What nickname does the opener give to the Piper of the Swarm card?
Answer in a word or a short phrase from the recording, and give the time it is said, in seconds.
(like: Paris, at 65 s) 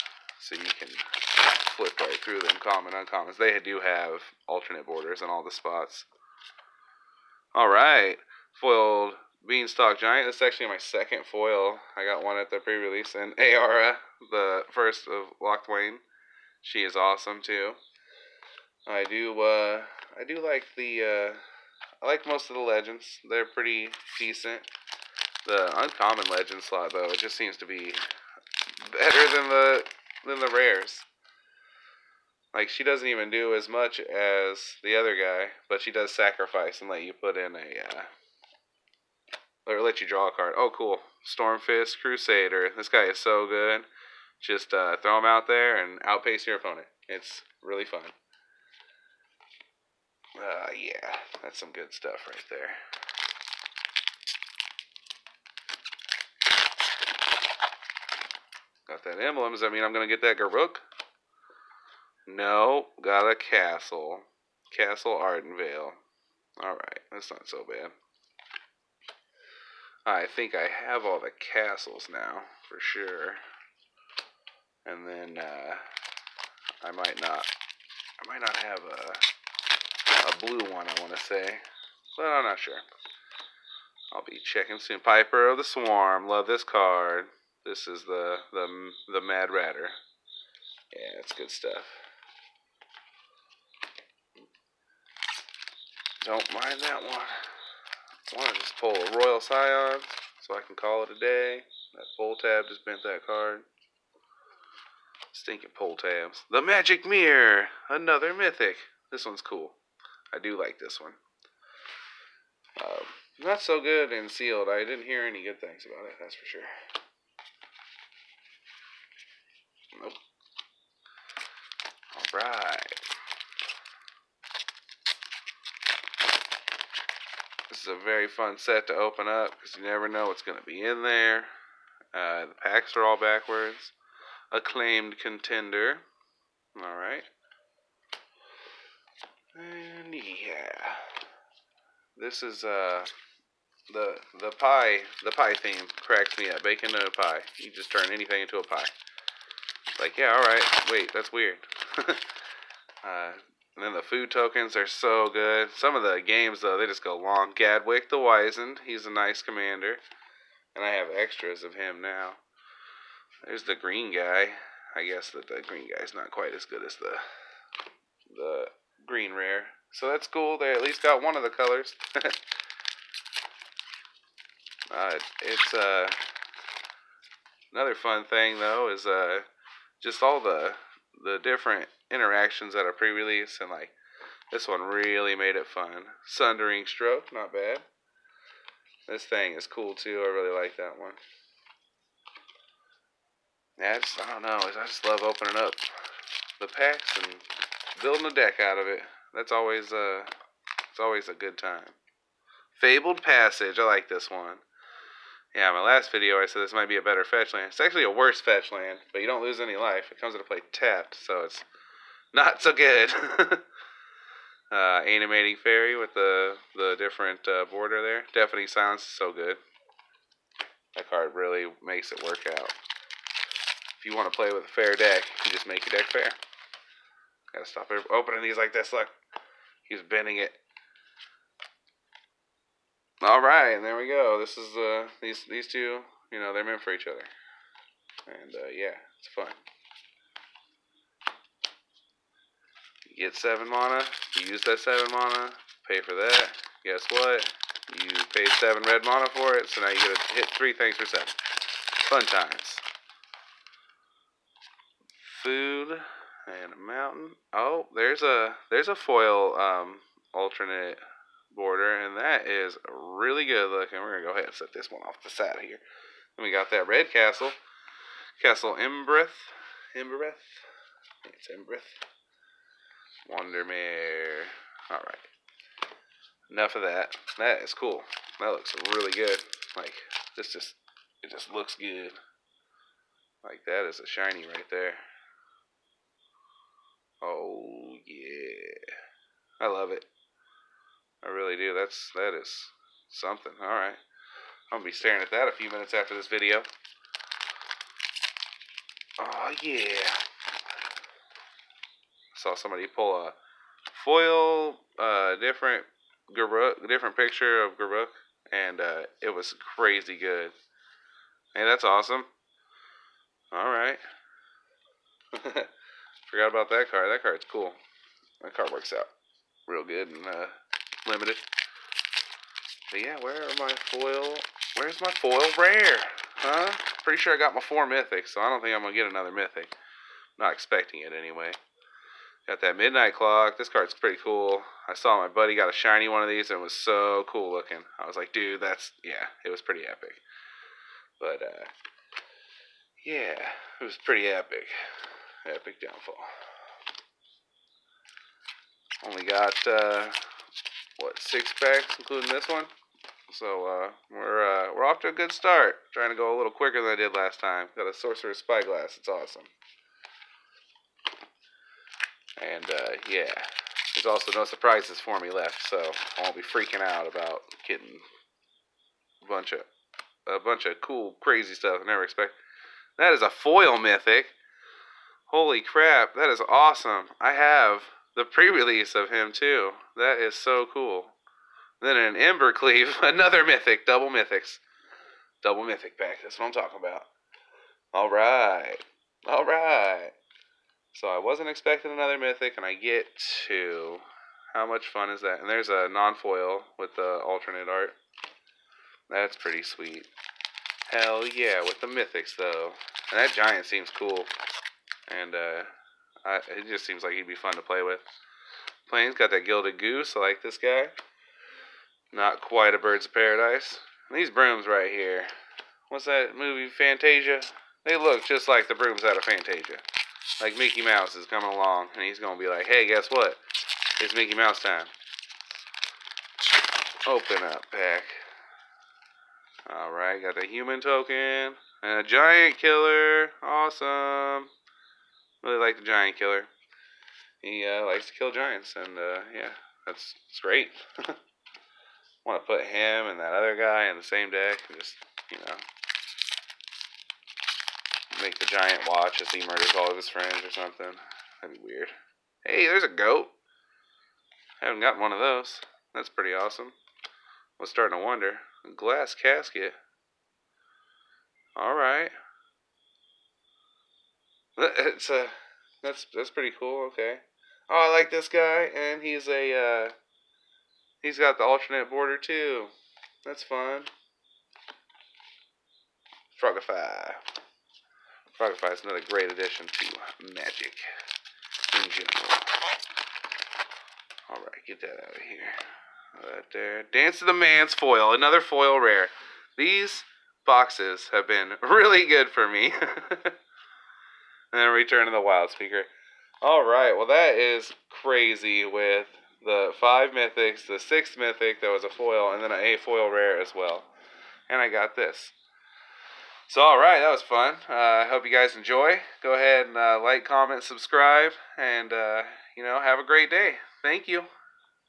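The Mad Ratter, at 89 s.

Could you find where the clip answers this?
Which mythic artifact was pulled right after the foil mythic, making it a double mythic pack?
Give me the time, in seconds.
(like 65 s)
382 s.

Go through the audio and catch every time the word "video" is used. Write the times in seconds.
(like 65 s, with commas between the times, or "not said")
206 s, 296 s.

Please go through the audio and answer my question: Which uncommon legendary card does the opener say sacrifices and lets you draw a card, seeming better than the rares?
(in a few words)
Ayara the first of Locthwain.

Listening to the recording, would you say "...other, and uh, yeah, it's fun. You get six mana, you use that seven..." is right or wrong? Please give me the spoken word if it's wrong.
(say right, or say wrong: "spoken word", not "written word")
wrong: "seven", not "six".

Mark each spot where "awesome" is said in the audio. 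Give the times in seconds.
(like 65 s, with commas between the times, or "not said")
16 s, 311 s, 359 s, 376 s, 433 s, 456 s.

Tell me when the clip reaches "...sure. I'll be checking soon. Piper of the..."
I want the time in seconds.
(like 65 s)
82 s.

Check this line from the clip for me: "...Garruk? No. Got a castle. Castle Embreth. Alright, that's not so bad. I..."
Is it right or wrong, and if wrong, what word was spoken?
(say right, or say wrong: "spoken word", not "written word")
wrong: "Ardenvale", not "Embreth".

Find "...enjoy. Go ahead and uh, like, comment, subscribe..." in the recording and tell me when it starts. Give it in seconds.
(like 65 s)
508 s.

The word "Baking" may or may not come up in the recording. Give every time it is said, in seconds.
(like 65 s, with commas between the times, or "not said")
146 s.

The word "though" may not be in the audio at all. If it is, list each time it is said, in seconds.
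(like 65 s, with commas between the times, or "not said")
26 s, 156 s, 178 s, 402 s.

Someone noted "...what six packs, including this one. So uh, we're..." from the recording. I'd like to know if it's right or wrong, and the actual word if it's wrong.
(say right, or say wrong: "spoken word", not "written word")
right.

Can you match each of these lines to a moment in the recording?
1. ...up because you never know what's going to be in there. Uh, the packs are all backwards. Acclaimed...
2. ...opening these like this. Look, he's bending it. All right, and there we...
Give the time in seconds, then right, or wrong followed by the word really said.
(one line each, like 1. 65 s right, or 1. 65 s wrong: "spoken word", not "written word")
1. 129 s right
2. 228 s right.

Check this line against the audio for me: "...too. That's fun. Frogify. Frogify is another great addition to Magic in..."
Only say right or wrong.
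right.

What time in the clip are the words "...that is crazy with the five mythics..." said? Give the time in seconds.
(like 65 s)
497 s.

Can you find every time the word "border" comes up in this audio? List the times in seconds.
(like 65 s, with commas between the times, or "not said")
4 s, 217 s, 261 s, 471 s.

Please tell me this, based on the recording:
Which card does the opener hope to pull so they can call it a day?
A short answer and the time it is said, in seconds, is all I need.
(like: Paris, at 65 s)
Royal Scion, at 99 s.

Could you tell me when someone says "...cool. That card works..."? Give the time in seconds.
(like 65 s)
317 s.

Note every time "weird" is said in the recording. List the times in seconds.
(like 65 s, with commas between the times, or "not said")
151 s, 451 s.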